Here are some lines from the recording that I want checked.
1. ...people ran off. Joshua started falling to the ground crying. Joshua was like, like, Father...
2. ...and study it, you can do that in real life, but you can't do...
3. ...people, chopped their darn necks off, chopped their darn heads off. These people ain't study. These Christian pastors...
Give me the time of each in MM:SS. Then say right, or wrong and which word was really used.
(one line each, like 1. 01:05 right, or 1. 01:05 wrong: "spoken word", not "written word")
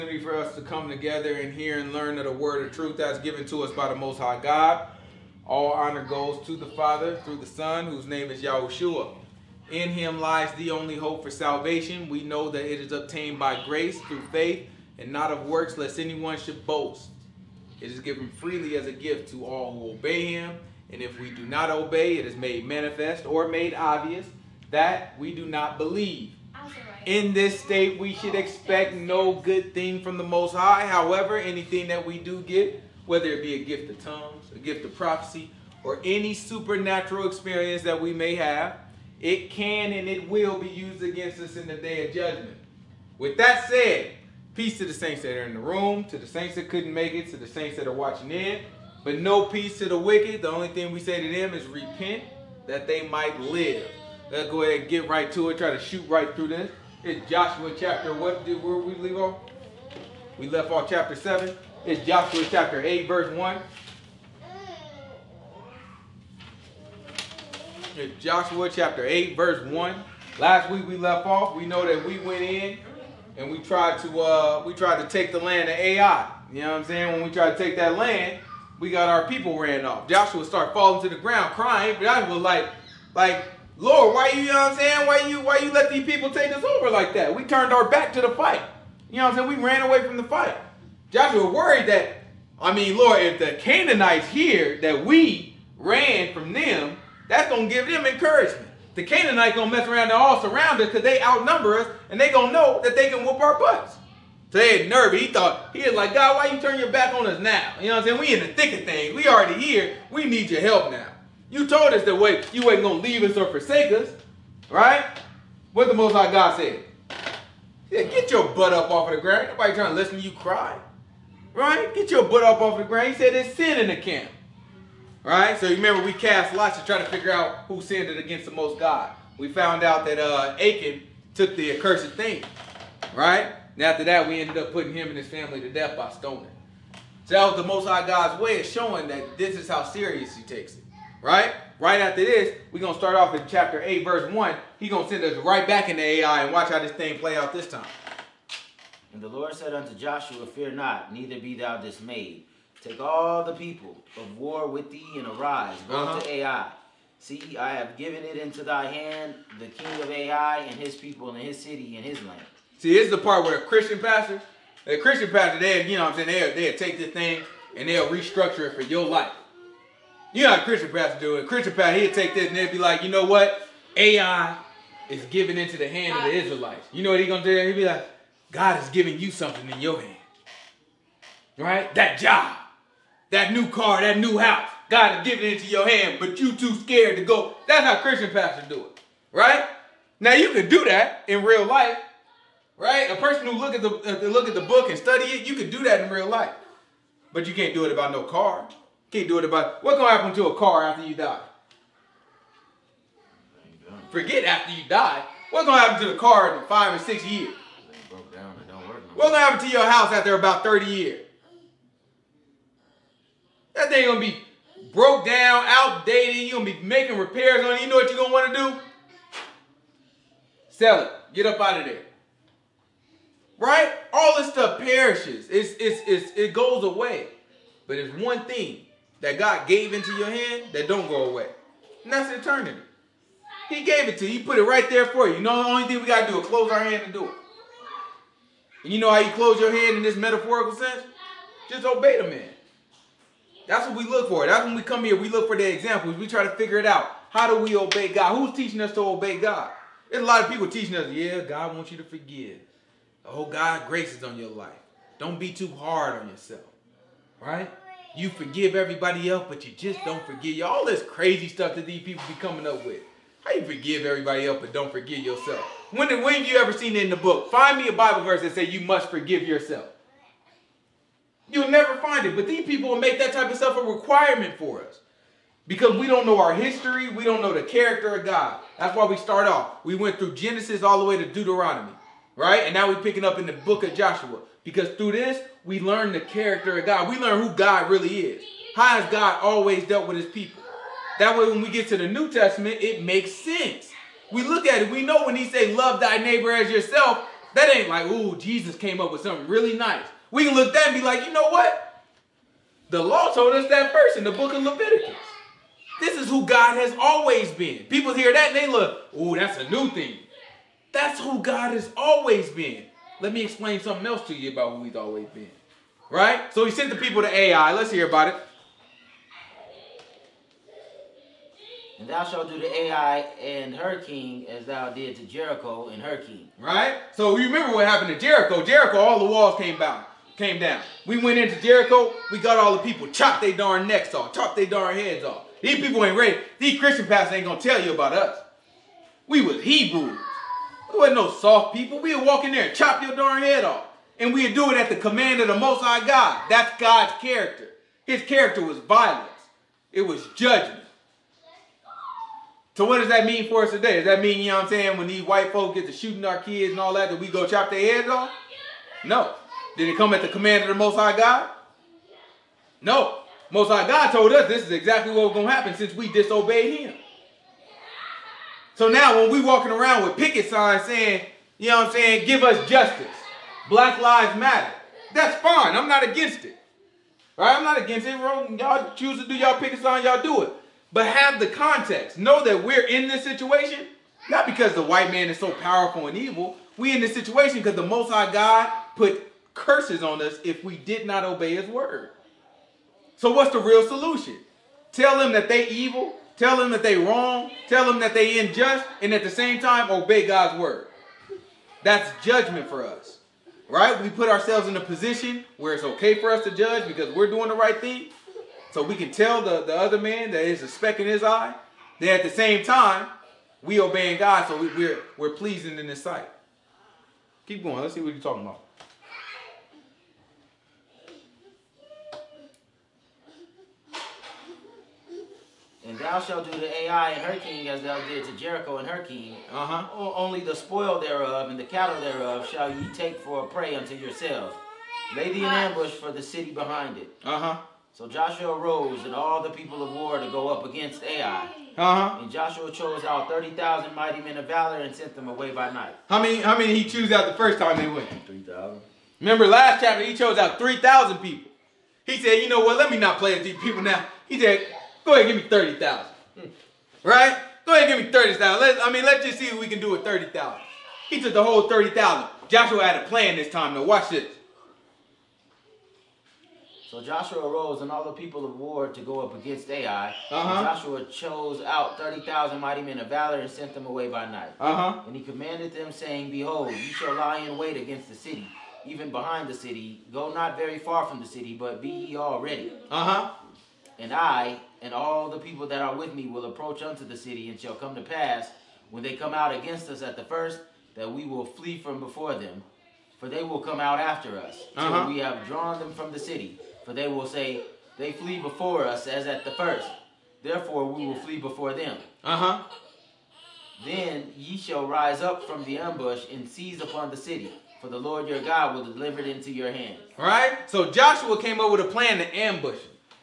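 1. 01:19 wrong: "Lord", not "Father"
2. 03:14 right
3. 05:32 wrong: "ready", not "study".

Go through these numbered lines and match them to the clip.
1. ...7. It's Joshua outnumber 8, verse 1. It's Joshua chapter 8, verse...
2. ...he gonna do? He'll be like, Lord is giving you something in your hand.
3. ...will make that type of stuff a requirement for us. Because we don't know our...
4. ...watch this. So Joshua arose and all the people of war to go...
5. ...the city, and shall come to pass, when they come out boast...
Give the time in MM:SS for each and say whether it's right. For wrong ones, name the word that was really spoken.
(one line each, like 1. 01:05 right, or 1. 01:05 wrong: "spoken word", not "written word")
1. 01:01 wrong: "chapter", not "outnumber"
2. 02:57 wrong: "God", not "Lord"
3. 04:32 right
4. 07:43 right
5. 08:07 wrong: "against", not "boast".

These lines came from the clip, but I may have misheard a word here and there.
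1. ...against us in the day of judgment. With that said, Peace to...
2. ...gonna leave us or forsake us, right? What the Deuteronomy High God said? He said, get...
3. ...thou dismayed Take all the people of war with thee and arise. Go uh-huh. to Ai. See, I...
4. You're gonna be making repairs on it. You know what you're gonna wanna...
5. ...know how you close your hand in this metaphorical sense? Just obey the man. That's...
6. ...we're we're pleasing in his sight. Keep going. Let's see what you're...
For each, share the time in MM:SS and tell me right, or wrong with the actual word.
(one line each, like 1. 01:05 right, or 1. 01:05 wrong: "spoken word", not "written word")
1. 00:41 right
2. 01:52 wrong: "Most", not "Deuteronomy"
3. 02:31 right
4. 03:36 right
5. 03:58 right
6. 06:54 right.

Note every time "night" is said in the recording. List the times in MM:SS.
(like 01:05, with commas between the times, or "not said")
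07:25, 07:54.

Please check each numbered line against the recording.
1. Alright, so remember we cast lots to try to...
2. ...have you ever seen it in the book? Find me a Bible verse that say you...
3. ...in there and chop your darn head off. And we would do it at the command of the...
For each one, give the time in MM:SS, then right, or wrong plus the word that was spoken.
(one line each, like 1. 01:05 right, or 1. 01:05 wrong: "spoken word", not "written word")
1. 02:05 right
2. 04:26 right
3. 05:42 right.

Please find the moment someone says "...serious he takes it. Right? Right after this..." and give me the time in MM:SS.
02:19.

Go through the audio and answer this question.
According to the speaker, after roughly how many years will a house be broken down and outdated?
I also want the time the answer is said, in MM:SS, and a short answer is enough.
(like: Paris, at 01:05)
30 years, at 03:30.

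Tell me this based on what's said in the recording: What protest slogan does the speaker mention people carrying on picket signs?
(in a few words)
Black Lives Matter.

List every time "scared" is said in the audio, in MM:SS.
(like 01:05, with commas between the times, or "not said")
03:06.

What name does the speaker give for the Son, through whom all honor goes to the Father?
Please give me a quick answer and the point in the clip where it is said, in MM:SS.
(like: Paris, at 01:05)
Yahushua, at 00:08.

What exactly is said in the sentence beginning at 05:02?
The law told us that first in the book of Leviticus.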